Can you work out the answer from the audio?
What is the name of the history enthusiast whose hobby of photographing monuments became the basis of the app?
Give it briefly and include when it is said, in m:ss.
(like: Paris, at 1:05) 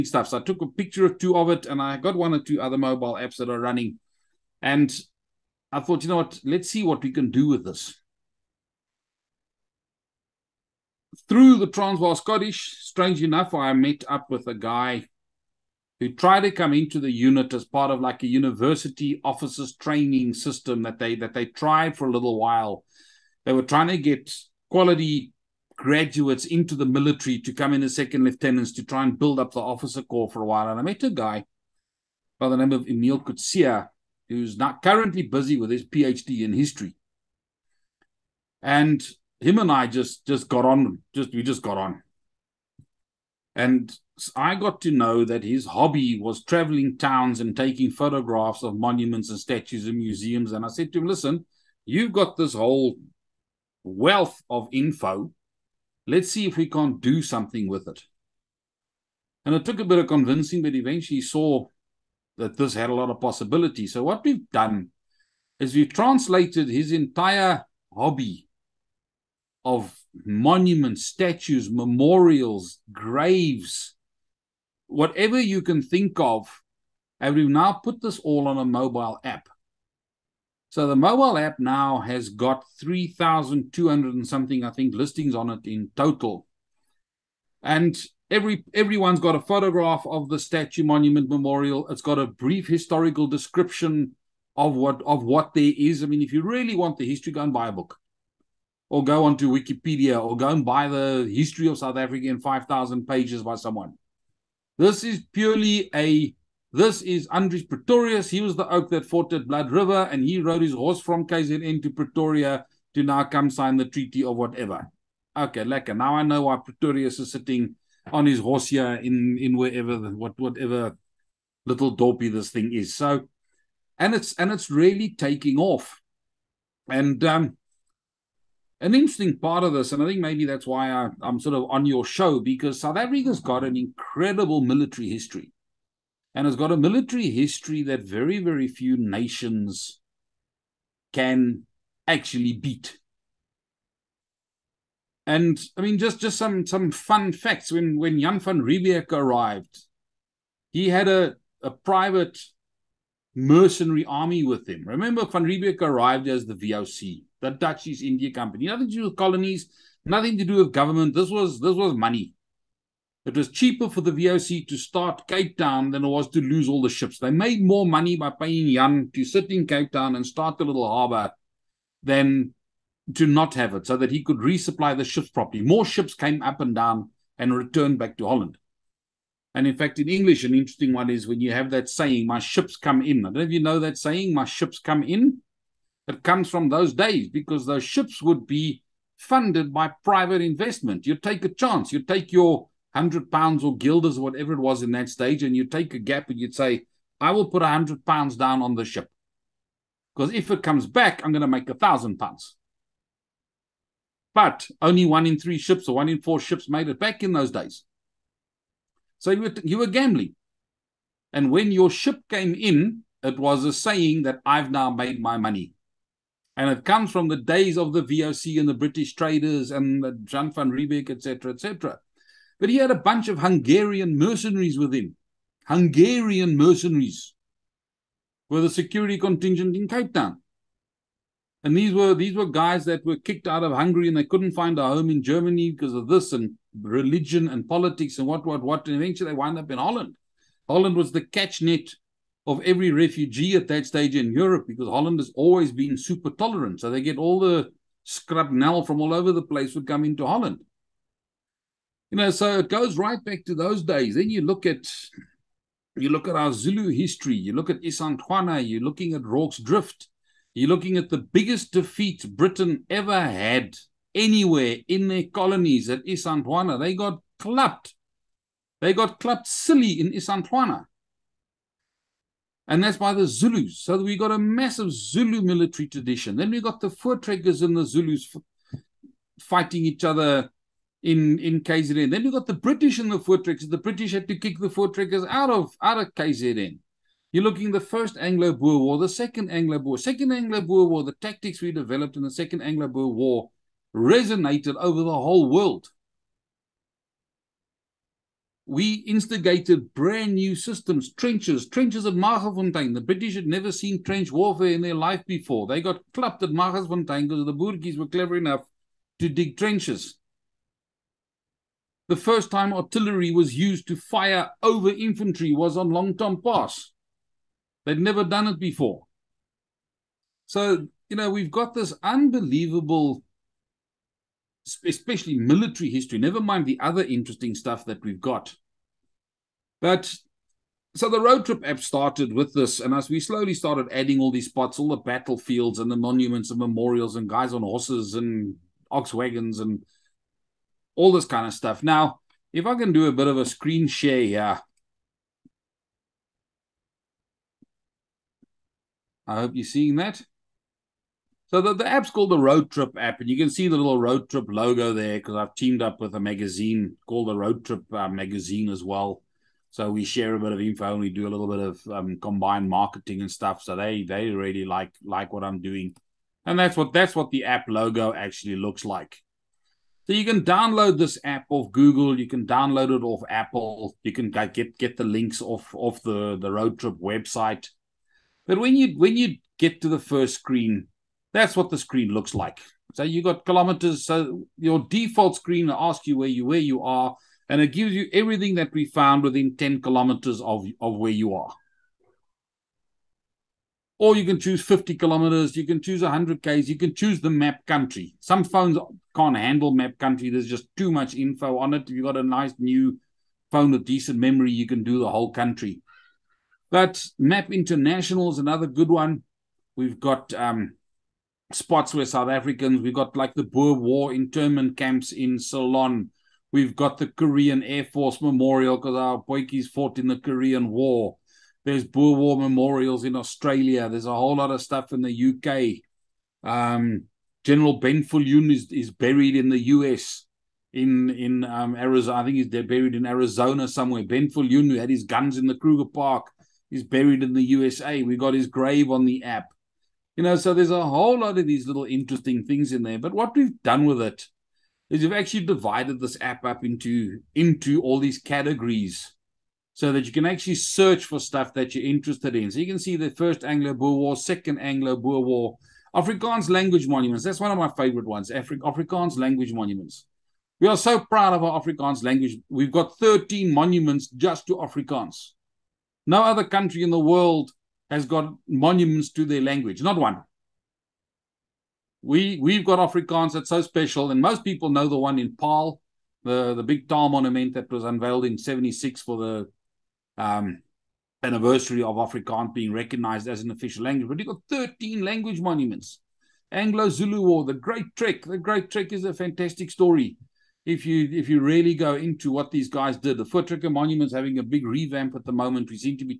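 Emil Kutsia, at 0:32.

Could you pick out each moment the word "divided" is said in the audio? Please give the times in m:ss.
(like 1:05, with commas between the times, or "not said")
7:25.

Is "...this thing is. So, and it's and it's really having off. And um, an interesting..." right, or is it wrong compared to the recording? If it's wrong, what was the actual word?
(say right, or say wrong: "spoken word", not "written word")
wrong: "taking", not "having".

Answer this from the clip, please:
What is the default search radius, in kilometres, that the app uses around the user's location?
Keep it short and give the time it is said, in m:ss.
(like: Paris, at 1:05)
10, at 6:29.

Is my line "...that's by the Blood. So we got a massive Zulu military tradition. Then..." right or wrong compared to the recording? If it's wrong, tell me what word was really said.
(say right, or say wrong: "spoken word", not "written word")
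wrong: "Zulus", not "Blood".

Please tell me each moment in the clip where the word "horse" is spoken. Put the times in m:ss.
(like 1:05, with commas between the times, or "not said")
1:50, 1:58, 5:37.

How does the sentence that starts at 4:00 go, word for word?
Holland was the catch net of every refugee at that stage in Europe because Holland has always been super tolerant.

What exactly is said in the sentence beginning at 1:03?
So, what we've done is we've translated his entire hobby of monuments, statues, memorials, graves, whatever you can think of.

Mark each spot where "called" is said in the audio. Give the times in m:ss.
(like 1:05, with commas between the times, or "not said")
5:52, 5:57.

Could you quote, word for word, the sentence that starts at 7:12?
I think he's buried in Arizona somewhere.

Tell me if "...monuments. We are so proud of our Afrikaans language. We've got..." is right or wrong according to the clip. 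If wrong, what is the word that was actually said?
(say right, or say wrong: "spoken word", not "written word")
right.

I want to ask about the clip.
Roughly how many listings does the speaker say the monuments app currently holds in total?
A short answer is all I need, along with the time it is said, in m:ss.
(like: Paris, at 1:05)
3,200, at 1:22.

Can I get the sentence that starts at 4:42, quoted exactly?
Then you got the British in the Voortrekkers.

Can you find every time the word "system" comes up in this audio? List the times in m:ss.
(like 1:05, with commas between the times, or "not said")
0:20, 5:00.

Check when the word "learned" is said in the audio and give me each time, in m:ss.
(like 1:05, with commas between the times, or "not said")
not said.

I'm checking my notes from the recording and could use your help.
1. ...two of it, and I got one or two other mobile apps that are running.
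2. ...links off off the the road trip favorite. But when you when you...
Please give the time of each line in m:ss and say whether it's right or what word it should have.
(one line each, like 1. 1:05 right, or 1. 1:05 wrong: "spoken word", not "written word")
1. 0:01 right
2. 6:15 wrong: "website", not "favorite".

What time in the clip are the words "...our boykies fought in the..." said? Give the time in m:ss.
6:58.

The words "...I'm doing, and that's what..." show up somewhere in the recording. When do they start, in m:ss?
6:05.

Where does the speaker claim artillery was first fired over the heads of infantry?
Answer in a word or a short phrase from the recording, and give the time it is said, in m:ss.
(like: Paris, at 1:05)
Long Tom Pass, at 5:15.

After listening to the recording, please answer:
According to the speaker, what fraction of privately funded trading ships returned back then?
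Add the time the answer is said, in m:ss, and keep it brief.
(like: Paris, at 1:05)
one in three, at 3:25.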